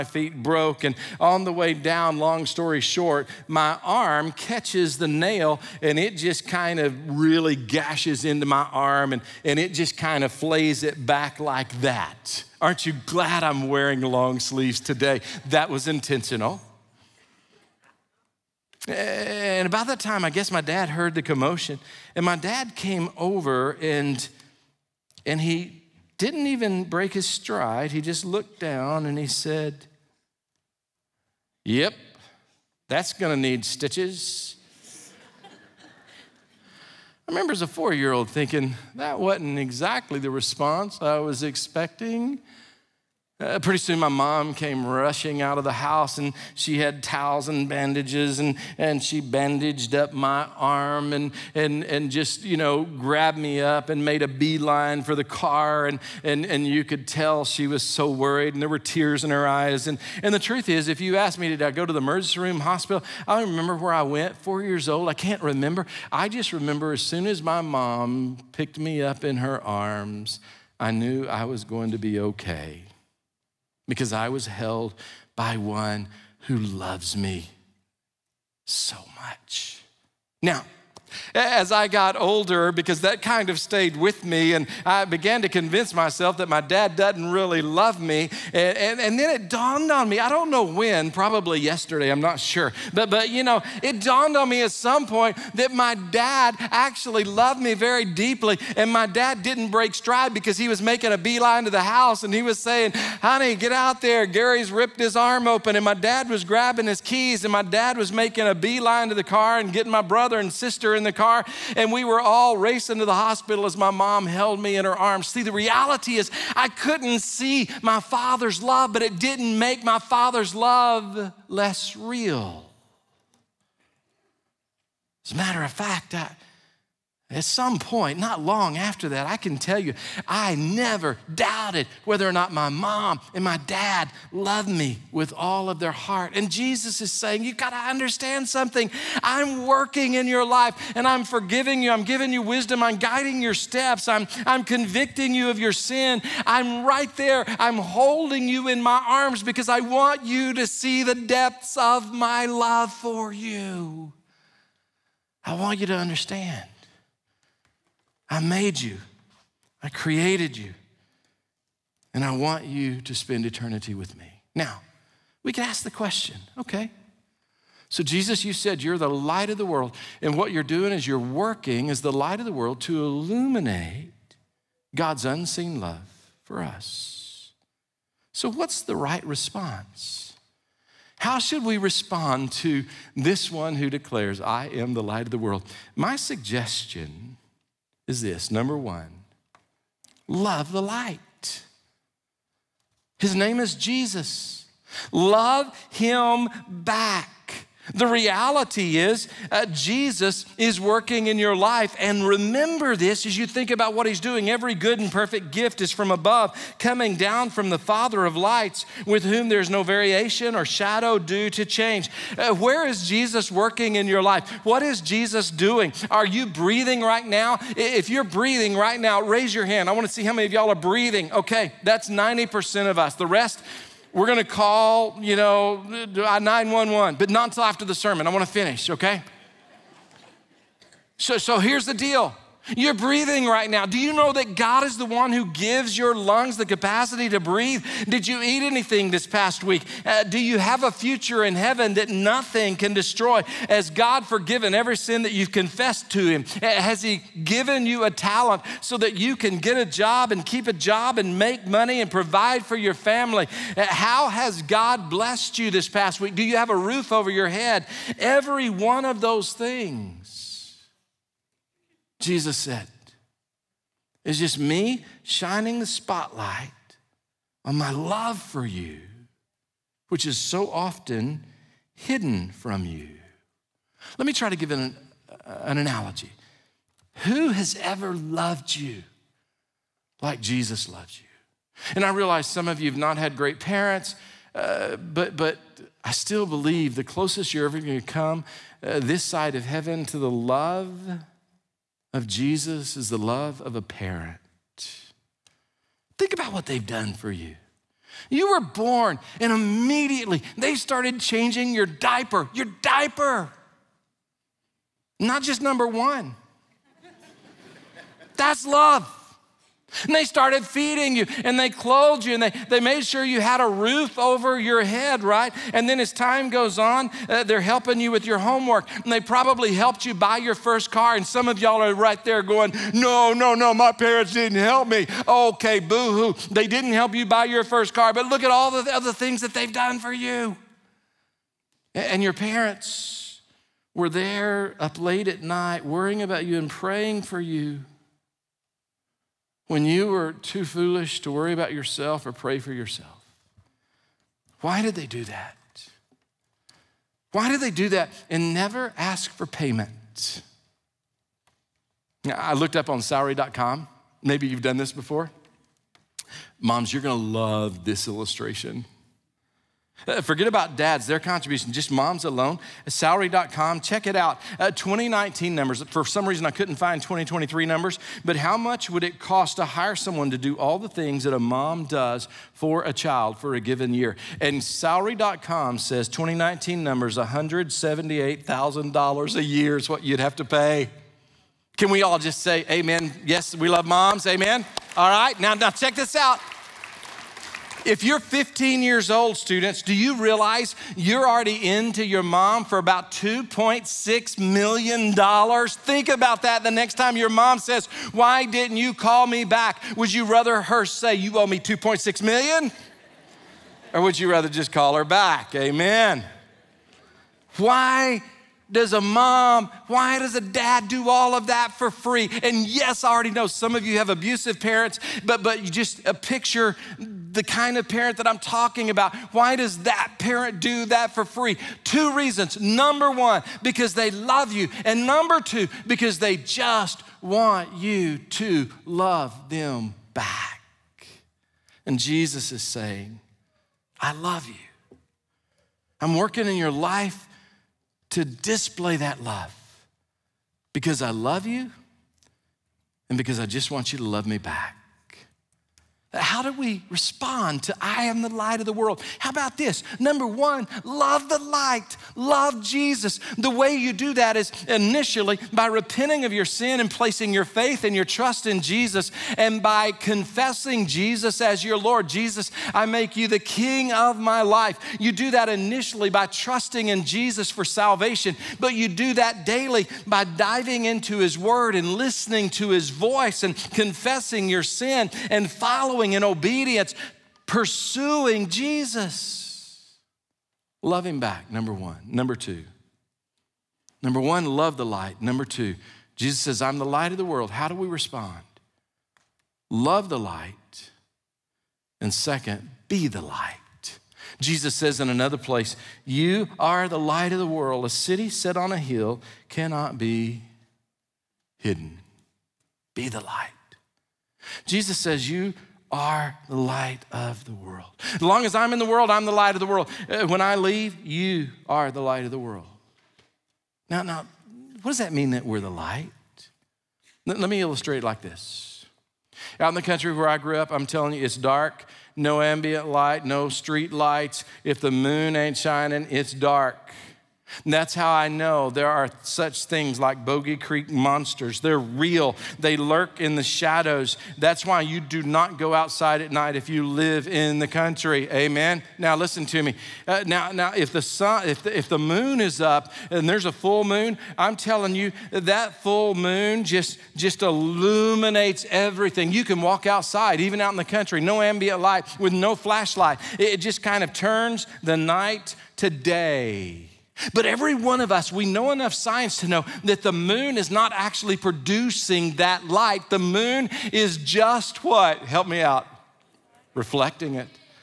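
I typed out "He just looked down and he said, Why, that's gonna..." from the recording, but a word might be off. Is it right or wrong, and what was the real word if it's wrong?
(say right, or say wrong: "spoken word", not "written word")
wrong: "Yep", not "Why".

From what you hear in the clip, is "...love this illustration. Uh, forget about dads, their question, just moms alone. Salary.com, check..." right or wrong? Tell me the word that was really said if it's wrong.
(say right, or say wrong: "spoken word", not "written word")
wrong: "contribution", not "question".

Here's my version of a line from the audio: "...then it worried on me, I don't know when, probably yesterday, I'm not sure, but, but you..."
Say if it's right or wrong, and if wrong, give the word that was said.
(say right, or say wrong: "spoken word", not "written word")
wrong: "dawned", not "worried".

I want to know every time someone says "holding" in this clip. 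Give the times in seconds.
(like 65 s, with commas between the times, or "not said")
147 s.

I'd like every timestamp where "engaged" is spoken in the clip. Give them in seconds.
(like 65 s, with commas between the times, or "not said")
not said.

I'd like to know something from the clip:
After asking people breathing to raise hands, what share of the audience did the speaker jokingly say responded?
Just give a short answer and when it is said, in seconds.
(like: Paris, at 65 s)
90%, at 222 s.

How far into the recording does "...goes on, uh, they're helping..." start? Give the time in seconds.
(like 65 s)
316 s.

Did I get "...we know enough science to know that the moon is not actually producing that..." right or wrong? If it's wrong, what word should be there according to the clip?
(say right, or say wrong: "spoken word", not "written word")
right.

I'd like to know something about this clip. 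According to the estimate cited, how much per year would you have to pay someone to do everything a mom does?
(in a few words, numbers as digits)
$178,000.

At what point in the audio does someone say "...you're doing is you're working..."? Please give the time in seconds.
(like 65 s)
170 s.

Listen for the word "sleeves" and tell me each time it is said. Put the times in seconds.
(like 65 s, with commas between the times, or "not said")
14 s.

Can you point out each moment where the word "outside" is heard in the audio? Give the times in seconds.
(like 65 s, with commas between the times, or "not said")
535 s, 549 s.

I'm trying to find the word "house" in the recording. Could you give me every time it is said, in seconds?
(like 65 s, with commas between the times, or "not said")
45 s, 101 s.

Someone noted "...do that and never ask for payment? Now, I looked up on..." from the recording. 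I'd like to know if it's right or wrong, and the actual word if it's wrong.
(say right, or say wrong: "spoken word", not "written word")
right.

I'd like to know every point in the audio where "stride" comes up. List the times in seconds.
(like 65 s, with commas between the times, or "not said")
27 s, 99 s.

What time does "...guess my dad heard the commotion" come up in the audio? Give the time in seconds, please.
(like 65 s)
20 s.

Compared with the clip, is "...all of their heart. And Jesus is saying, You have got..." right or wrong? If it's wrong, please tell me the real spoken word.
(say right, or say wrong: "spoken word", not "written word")
right.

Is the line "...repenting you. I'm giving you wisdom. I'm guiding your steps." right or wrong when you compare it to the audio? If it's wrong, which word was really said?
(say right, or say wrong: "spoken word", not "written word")
wrong: "forgiving", not "repenting".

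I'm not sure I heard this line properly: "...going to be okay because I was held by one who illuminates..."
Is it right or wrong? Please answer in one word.
wrong.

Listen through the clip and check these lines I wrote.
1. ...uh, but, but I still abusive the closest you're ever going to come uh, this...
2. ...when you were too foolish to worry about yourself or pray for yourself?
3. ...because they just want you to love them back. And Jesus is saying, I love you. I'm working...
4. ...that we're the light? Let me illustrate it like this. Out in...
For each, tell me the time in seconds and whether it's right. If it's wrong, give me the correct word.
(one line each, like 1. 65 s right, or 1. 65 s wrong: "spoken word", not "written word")
1. 284 s wrong: "believe", not "abusive"
2. 339 s right
3. 425 s right
4. 515 s right.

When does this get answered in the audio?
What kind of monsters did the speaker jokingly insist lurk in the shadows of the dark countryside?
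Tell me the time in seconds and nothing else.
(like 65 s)
530 s.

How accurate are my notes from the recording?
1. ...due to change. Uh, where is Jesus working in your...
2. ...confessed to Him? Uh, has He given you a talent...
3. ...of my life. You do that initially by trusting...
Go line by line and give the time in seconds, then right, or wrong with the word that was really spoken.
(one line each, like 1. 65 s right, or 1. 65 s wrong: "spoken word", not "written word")
1. 211 s right
2. 245 s right
3. 463 s right.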